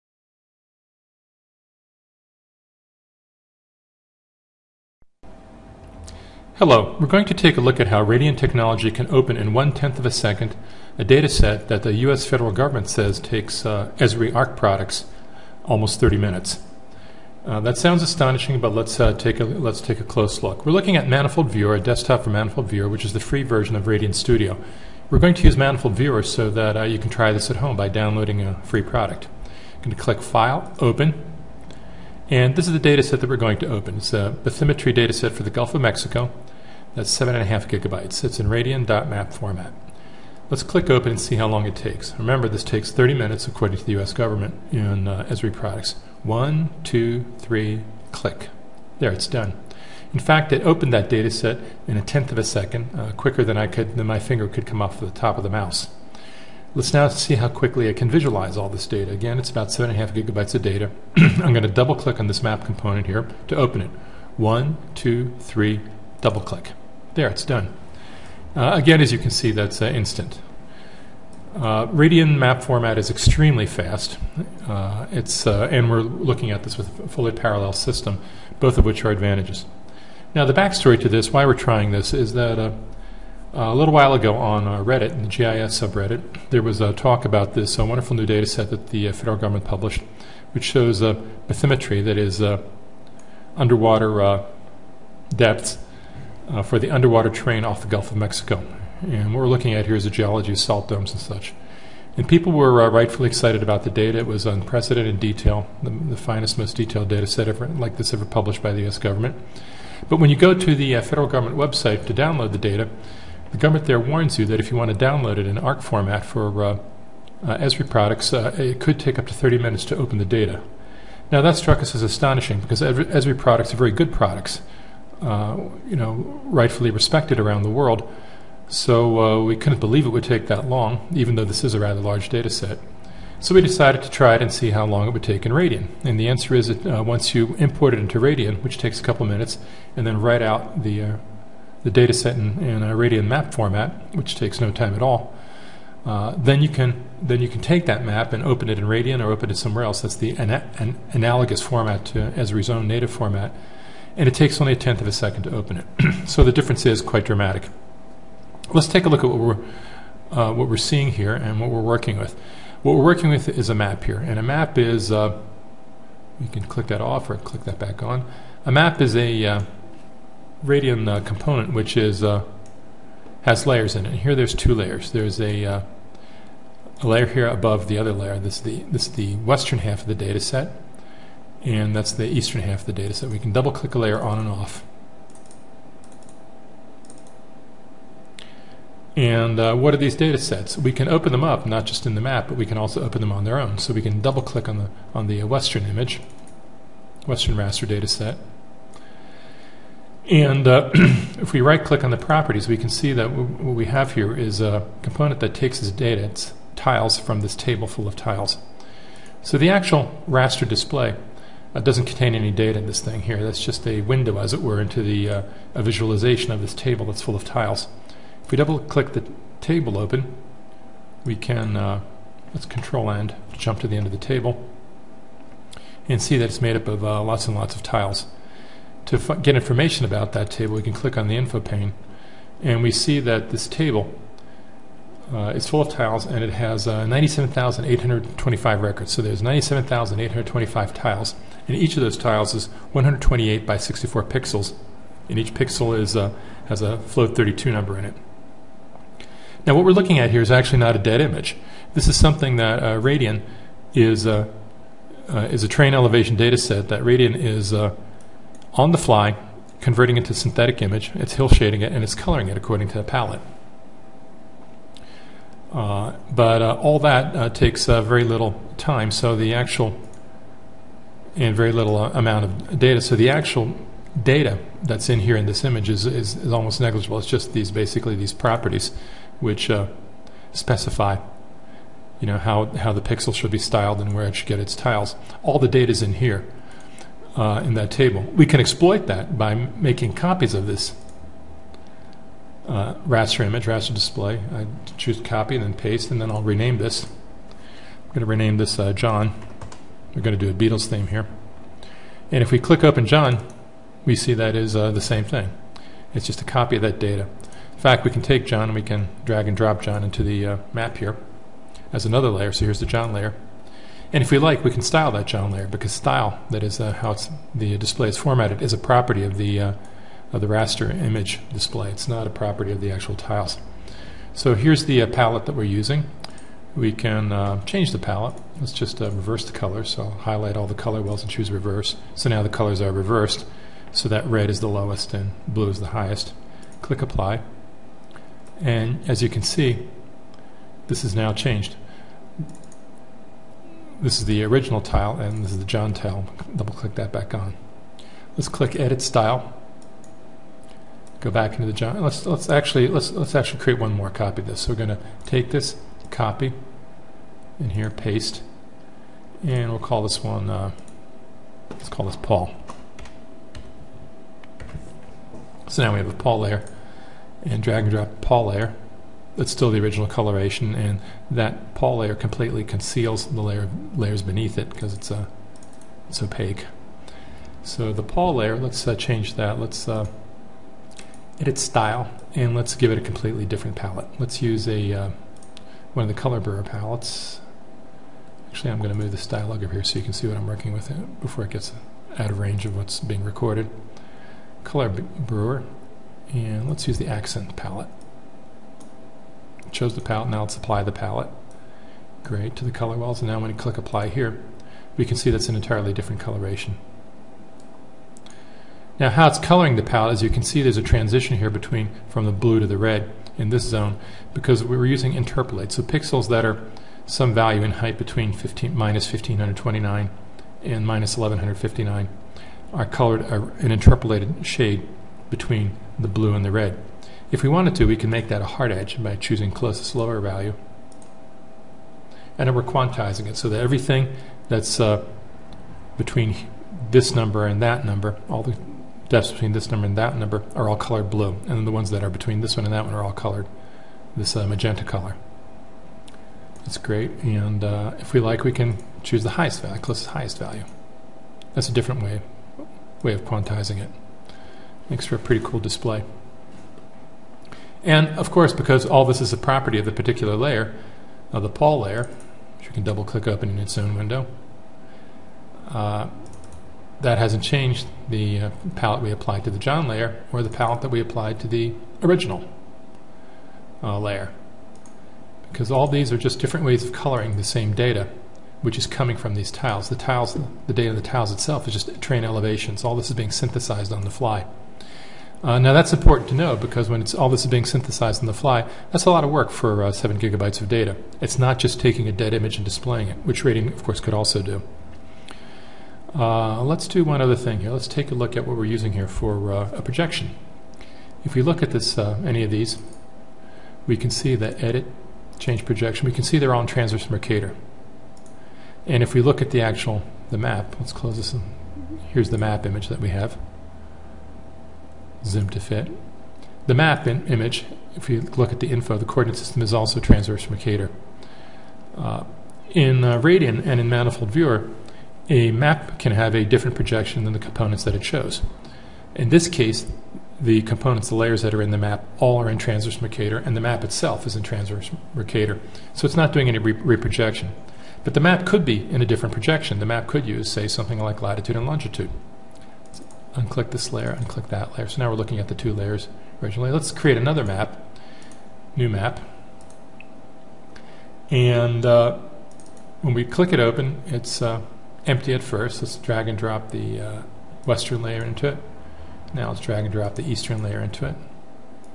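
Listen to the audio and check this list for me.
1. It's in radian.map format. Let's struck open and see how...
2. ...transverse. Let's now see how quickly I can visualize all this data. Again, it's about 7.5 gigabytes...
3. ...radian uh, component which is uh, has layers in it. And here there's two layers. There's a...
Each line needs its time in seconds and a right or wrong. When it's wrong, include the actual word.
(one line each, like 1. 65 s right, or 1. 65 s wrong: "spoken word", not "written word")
1. 38 s wrong: "click", not "struck"
2. 55 s wrong: "mouse", not "transverse"
3. 170 s right.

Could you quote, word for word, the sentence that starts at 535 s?
So it's not doing any re reprojection.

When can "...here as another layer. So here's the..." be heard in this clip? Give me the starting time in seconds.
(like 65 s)
310 s.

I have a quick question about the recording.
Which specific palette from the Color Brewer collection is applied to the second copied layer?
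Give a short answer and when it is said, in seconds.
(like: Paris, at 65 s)
accent, at 397 s.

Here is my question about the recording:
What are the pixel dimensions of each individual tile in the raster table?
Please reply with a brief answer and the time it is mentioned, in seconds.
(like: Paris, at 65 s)
128 by 64, at 242 s.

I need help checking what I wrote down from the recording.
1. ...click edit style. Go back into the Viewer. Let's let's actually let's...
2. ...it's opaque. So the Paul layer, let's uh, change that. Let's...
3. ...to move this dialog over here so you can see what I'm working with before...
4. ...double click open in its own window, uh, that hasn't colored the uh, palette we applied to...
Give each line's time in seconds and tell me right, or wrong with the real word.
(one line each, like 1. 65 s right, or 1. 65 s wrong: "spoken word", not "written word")
1. 348 s wrong: "John", not "Viewer"
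2. 376 s right
3. 388 s right
4. 462 s wrong: "changed", not "colored".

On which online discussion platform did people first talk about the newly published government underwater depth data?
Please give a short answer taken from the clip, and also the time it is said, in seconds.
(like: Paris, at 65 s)
Reddit, at 84 s.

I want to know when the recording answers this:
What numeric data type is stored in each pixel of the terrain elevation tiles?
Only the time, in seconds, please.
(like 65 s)
246 s.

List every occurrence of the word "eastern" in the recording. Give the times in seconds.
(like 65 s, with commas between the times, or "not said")
182 s, 560 s.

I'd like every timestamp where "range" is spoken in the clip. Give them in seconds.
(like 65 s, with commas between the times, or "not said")
392 s.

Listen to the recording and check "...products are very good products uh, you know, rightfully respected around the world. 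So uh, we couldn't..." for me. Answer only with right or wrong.
right.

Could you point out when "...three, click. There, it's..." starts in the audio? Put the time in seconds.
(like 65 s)
47 s.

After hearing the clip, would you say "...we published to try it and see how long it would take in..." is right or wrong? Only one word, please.
wrong.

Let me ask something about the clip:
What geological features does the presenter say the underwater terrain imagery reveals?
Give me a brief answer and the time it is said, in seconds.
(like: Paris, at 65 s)
salt domes, at 100 s.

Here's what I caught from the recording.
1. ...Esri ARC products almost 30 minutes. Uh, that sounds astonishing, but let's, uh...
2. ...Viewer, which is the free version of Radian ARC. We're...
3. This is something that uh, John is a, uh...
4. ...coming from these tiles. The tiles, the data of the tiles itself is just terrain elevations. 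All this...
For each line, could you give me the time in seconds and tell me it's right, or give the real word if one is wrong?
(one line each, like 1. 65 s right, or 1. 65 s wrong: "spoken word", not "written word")
1. 13 s right
2. 22 s wrong: "Studio", not "ARC"
3. 251 s wrong: "Radian", not "John"
4. 478 s right.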